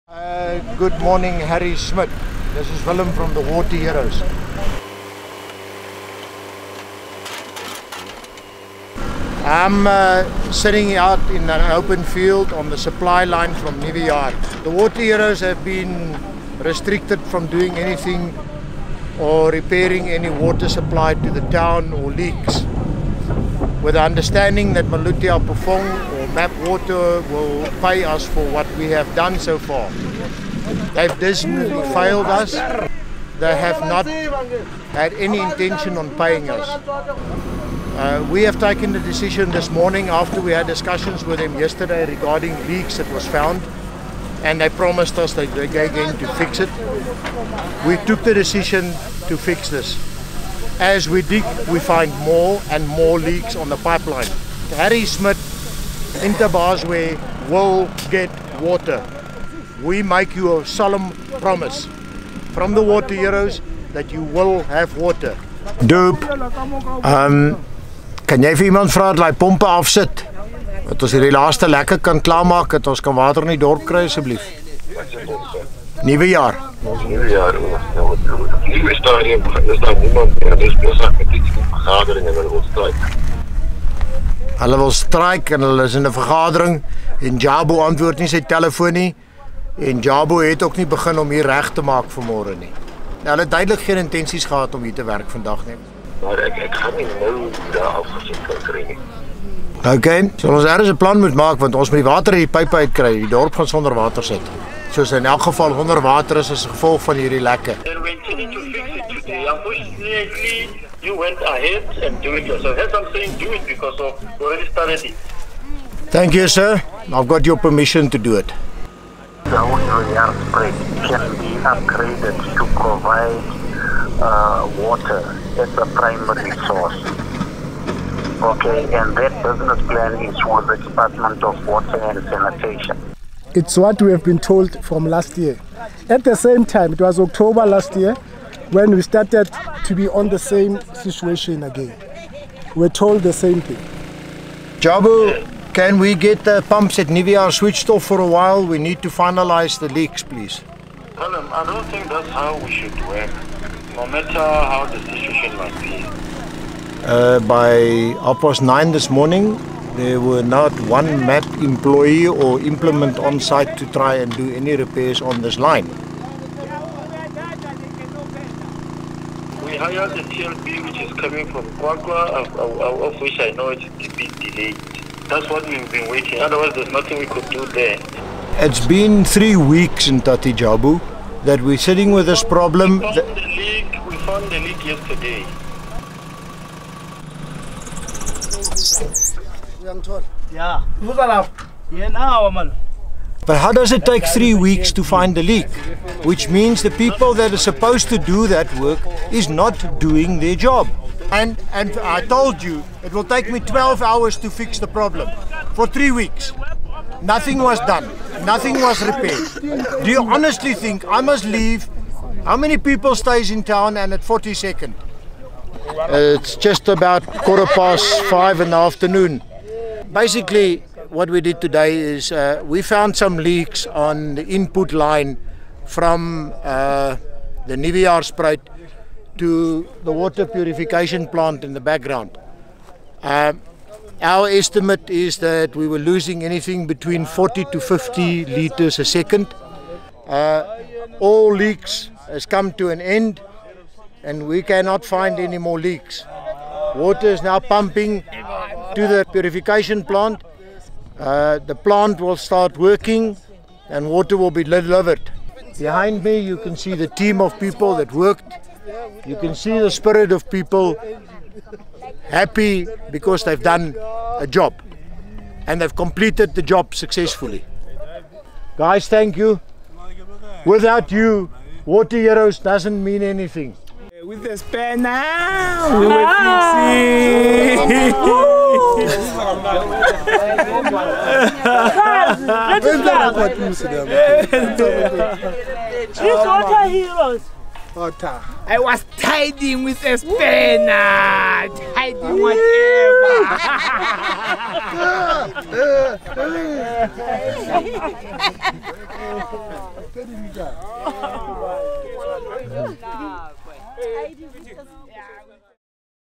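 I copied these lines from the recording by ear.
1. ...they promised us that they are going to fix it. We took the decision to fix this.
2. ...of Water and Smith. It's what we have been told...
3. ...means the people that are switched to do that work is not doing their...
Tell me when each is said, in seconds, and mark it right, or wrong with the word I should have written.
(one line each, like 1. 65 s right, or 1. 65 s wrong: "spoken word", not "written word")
1. 44 s right
2. 131 s wrong: "Sanitation", not "Smith"
3. 196 s wrong: "supposed", not "switched".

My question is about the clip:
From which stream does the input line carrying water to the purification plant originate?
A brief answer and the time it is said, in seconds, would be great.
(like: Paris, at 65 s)
Nuwejaarspruit, at 227 s.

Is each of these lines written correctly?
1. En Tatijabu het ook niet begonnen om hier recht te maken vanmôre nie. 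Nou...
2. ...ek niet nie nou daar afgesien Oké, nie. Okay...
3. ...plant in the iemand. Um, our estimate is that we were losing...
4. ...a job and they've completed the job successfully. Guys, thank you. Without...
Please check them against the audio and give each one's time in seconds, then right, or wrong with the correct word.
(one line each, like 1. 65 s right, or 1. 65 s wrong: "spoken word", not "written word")
1. 89 s wrong: "Jabo", not "Tatijabu"
2. 96 s right
3. 231 s wrong: "background", not "iemand"
4. 264 s right.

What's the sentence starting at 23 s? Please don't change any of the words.
With the understanding that Maluti-A-Phofung or MAP Water will pay us for what we have done so far.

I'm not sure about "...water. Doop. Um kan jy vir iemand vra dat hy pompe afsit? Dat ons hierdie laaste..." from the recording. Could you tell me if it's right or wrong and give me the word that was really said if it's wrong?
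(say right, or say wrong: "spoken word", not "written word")
right.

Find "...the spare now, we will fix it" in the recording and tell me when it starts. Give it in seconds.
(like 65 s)
274 s.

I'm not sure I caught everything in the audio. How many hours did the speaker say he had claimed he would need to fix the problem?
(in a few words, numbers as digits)
12.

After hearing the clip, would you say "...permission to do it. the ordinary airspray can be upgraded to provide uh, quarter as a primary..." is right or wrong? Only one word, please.
wrong.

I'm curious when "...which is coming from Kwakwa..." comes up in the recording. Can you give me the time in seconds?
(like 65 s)
170 s.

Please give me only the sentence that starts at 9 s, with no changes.
I'm uh, sitting out in an open field on the supply line from Nivea.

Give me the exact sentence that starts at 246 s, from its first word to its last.
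Water is now pumping to the purification plant.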